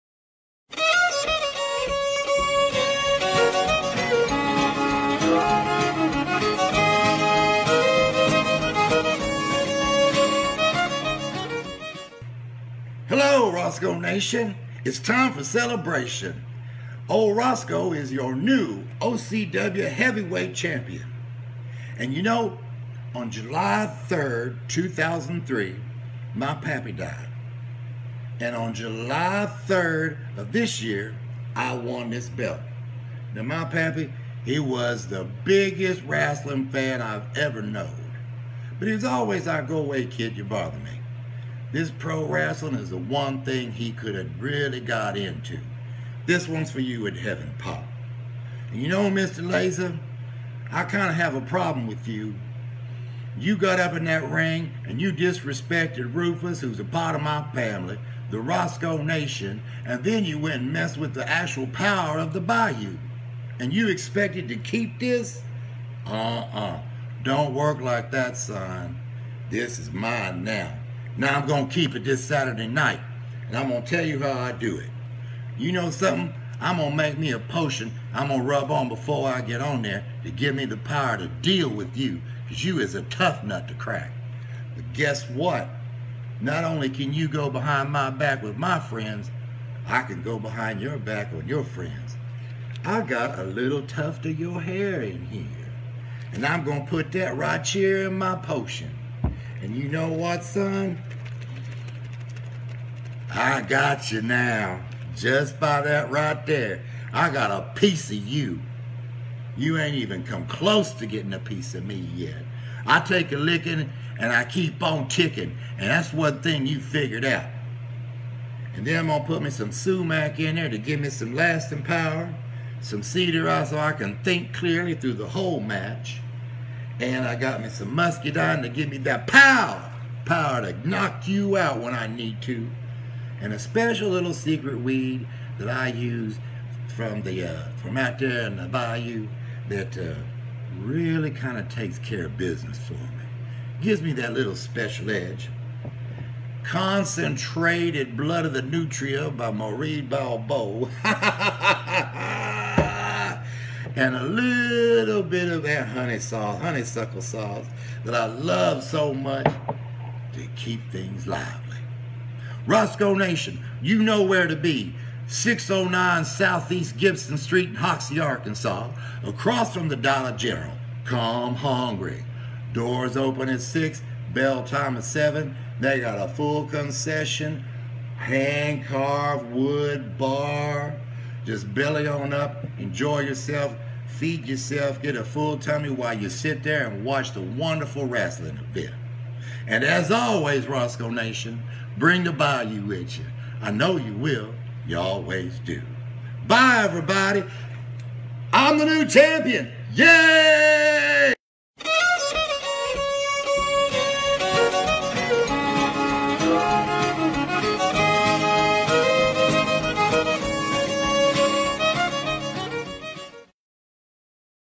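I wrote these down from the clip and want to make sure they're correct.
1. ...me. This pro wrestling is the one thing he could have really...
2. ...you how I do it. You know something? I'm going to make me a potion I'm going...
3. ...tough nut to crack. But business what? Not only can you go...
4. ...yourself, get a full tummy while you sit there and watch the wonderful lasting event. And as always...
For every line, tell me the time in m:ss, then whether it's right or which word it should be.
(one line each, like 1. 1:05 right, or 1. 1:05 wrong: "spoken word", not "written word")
1. 0:40 right
2. 1:14 right
3. 1:23 wrong: "guess", not "business"
4. 3:04 wrong: "wrestling", not "lasting".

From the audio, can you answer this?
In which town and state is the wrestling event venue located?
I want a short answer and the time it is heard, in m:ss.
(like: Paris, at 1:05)
Hoxie, Arkansas, at 2:47.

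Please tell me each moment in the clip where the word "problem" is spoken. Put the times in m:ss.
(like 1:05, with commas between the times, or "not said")
0:51.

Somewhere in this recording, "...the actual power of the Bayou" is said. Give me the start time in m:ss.
1:01.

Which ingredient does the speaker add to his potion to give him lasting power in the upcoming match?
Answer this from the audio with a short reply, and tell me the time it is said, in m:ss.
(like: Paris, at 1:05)
sumac, at 1:59.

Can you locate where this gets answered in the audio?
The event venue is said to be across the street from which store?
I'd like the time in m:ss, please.
2:49.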